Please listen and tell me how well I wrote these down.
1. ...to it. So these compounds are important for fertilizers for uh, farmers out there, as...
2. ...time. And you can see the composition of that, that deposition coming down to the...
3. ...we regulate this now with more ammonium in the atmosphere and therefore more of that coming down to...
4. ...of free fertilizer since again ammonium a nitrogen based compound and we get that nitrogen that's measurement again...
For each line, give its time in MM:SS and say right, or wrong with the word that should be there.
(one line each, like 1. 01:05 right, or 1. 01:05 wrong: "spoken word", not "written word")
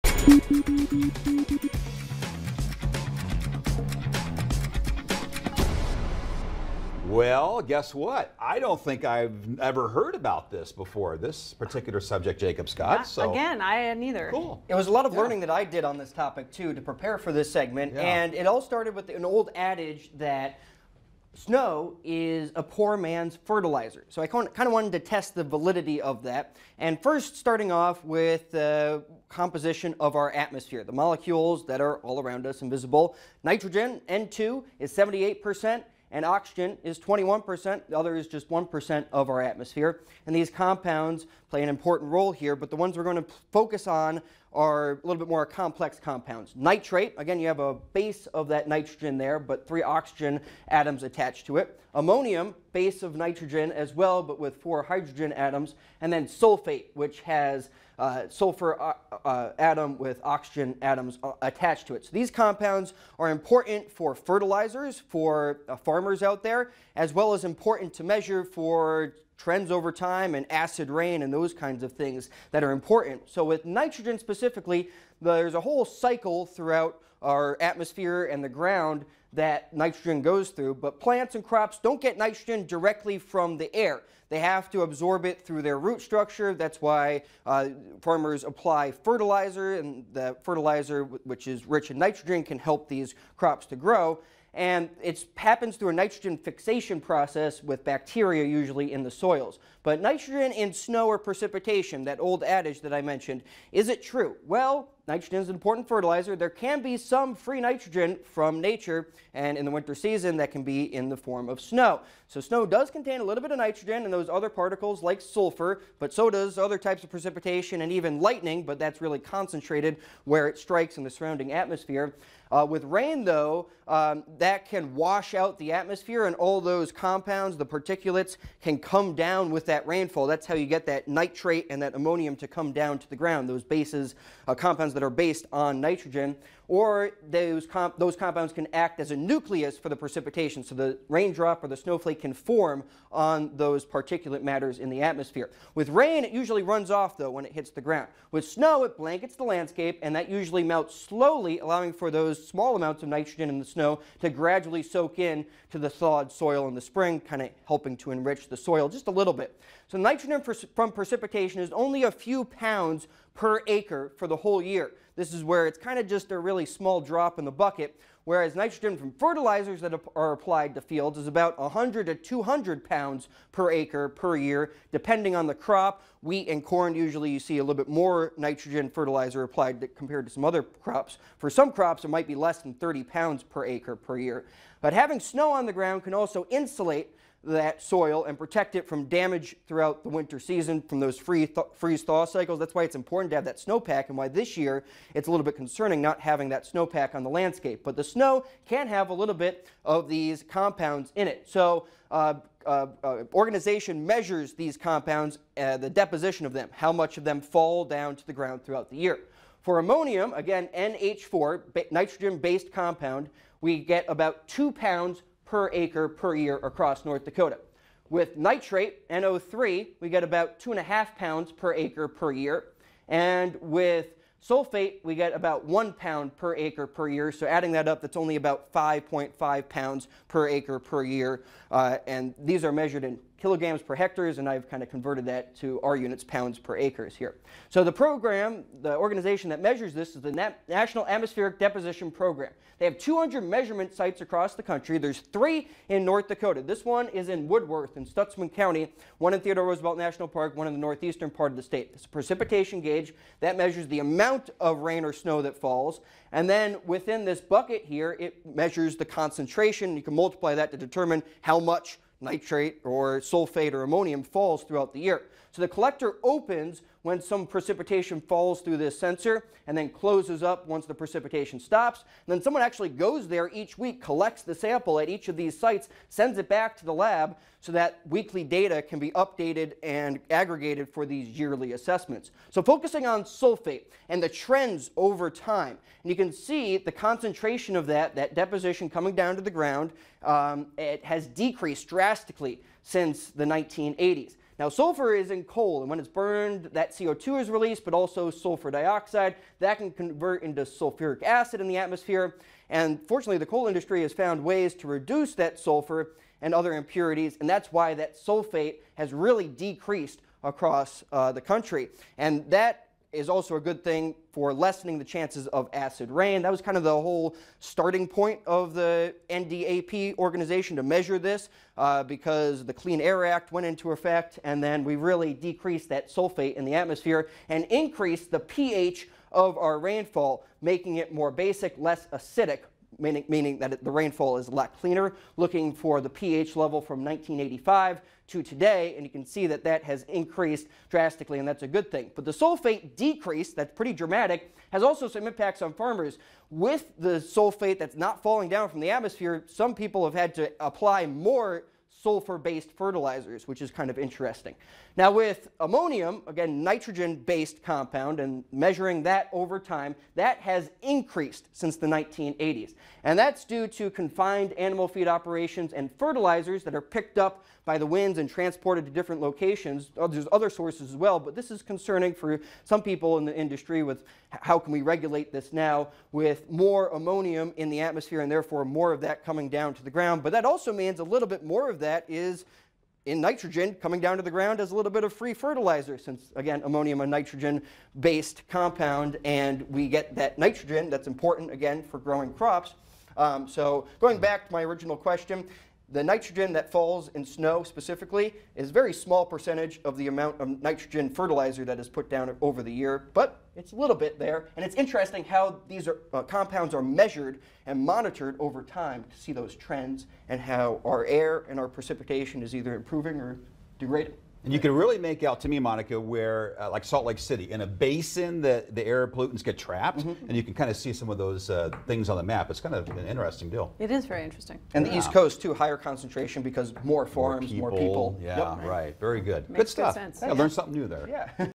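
1. 01:01 right
2. 04:45 wrong: "concentration", not "composition"
3. 06:14 right
4. 06:25 wrong: "important", not "measurement".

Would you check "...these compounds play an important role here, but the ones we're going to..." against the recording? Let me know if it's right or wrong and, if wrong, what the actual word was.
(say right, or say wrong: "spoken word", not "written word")
right.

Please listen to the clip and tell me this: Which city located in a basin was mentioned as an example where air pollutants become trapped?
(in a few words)
Salt Lake City.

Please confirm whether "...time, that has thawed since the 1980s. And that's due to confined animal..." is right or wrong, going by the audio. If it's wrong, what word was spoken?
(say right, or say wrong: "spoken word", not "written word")
wrong: "increased", not "thawed".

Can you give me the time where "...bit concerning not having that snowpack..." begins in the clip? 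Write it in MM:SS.
03:15.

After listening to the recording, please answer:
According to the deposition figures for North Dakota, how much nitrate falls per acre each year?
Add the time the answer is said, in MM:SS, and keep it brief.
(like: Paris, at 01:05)
2.5 pounds, at 03:40.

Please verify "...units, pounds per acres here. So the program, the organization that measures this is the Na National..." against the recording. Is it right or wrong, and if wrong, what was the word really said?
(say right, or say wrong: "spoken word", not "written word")
right.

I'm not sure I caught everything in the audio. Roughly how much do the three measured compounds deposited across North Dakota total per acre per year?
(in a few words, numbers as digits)
5.5 pounds.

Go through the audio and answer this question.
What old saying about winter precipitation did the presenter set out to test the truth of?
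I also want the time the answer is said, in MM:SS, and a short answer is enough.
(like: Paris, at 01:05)
Snow is a poor man's fertilizer, at 00:21.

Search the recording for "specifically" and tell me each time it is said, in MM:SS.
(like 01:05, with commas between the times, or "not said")
01:14, 06:37.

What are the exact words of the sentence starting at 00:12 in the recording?
Not, so Again, I had neither.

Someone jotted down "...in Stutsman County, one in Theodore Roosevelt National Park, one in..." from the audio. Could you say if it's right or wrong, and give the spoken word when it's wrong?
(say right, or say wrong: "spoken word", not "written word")
right.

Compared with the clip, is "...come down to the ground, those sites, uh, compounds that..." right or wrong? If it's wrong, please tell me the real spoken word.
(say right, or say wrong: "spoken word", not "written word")
wrong: "bases", not "sites".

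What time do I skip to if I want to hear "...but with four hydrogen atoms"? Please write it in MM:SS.
00:54.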